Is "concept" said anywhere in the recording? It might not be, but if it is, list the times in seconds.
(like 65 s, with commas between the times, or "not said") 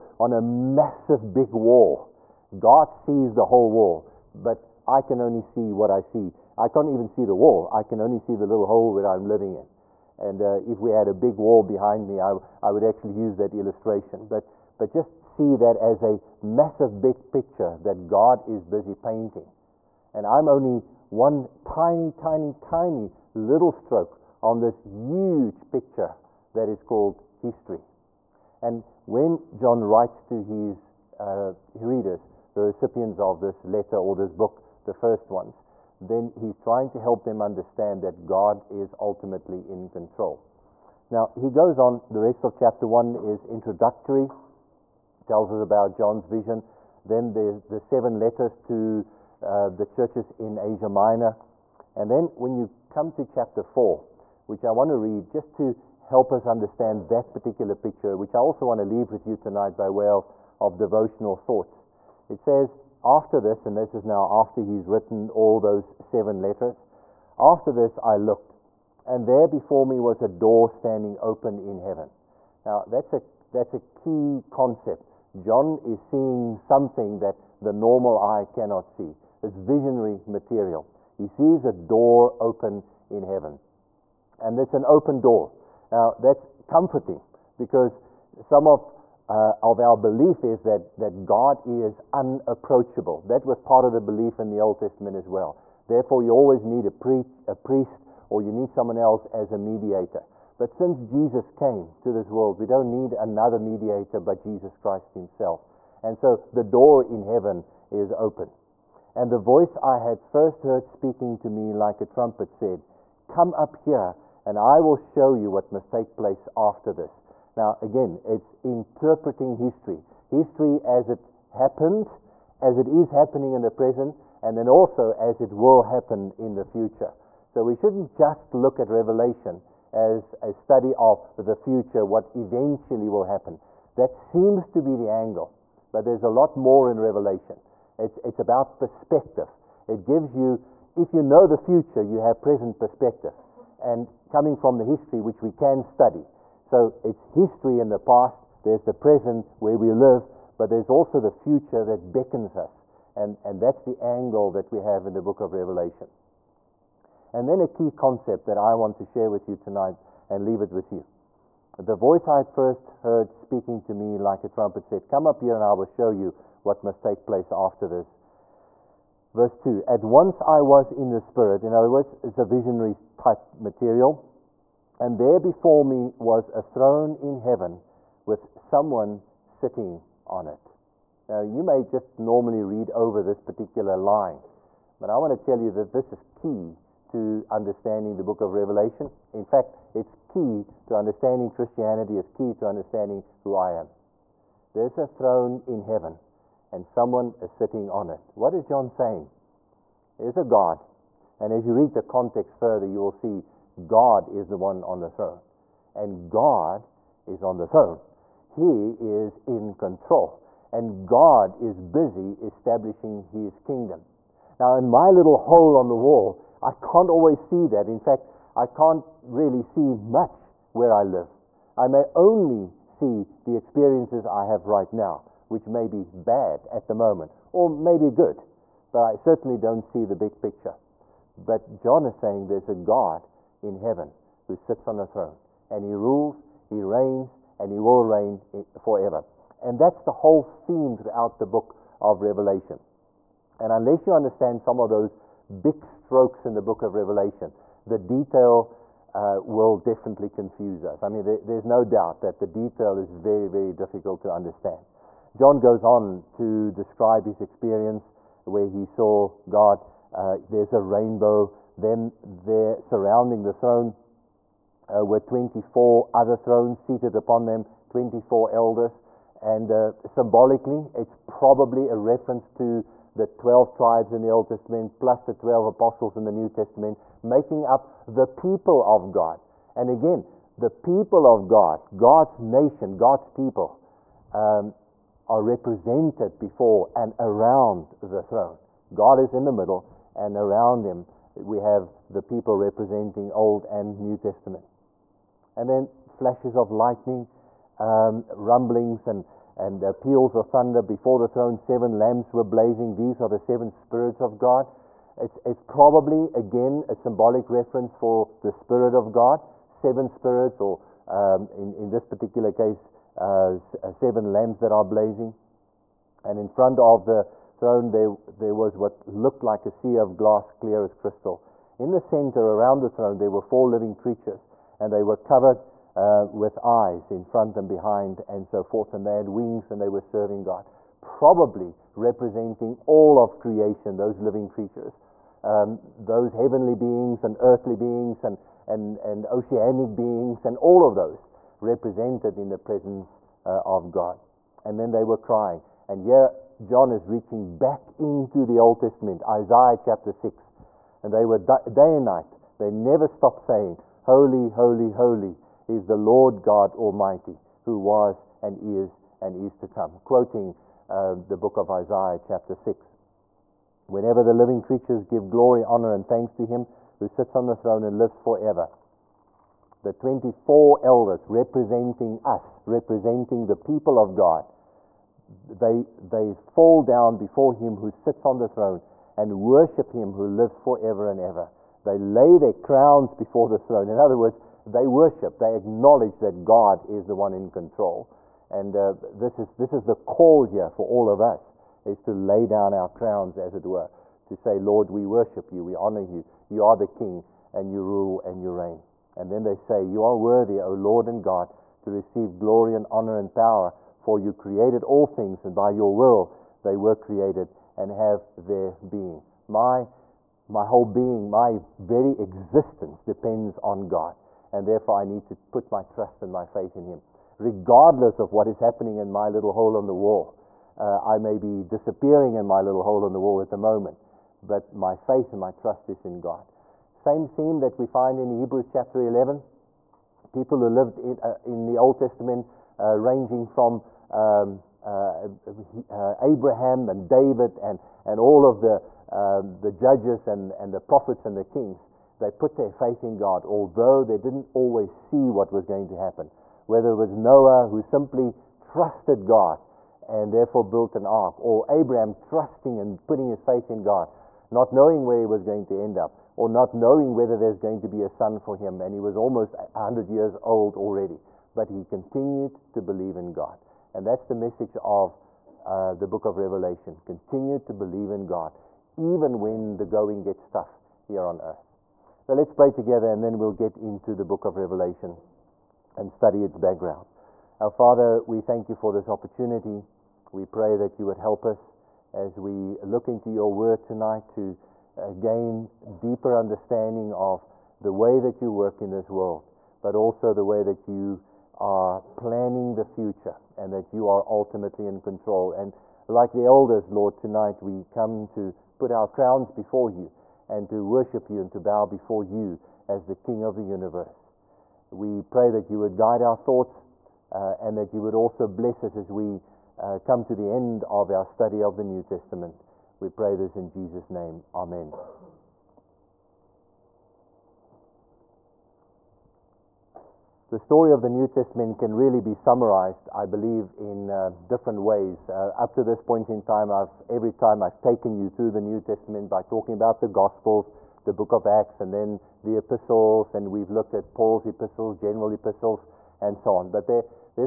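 74 s, 157 s.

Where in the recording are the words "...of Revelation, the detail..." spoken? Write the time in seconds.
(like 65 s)
246 s.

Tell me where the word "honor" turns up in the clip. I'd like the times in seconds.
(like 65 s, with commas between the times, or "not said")
365 s, 395 s, 402 s.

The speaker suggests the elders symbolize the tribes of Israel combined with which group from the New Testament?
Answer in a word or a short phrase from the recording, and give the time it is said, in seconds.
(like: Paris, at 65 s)
the 12 apostles, at 275 s.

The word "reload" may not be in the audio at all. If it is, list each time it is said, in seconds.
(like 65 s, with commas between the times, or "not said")
not said.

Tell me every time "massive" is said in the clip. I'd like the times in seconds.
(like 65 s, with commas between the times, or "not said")
0 s, 16 s.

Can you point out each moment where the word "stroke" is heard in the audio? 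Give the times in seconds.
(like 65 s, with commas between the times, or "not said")
23 s, 245 s.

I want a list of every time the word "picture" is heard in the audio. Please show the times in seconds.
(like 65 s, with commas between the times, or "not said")
17 s, 25 s, 57 s, 230 s.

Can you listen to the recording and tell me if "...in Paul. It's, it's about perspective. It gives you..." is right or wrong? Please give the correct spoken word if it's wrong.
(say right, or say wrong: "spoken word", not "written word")
wrong: "Revelation", not "Paul".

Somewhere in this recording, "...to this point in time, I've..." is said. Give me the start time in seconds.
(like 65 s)
525 s.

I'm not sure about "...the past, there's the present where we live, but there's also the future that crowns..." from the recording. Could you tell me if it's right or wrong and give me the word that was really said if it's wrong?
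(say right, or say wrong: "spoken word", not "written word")
wrong: "beckons", not "crowns".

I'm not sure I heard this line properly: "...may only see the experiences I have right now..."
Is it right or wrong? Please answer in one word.
right.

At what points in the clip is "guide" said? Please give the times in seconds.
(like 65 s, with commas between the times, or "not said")
505 s.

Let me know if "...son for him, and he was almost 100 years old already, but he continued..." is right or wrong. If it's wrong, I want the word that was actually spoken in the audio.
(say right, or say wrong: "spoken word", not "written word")
right.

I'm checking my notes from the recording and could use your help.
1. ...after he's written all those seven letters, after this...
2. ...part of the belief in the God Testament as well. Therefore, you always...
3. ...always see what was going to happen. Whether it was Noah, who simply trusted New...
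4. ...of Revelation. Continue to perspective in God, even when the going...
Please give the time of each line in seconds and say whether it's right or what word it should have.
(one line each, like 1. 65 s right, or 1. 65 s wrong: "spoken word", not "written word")
1. 64 s right
2. 93 s wrong: "Old", not "God"
3. 444 s wrong: "God", not "New"
4. 466 s wrong: "believe", not "perspective".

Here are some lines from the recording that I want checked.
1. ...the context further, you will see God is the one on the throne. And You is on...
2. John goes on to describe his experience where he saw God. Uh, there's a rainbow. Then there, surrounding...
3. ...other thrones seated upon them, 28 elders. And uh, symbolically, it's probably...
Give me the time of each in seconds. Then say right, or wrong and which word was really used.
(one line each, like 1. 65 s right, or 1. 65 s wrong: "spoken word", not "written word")
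1. 201 s wrong: "God", not "You"
2. 255 s right
3. 266 s wrong: "24", not "28".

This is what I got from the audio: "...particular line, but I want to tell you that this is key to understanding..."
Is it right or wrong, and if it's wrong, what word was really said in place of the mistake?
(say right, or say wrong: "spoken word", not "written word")
right.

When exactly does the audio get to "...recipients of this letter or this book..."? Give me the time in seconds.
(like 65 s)
32 s.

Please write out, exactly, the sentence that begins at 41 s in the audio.
Now, he goes on, the rest of chapter 1 is introductory, tells us about John's vision.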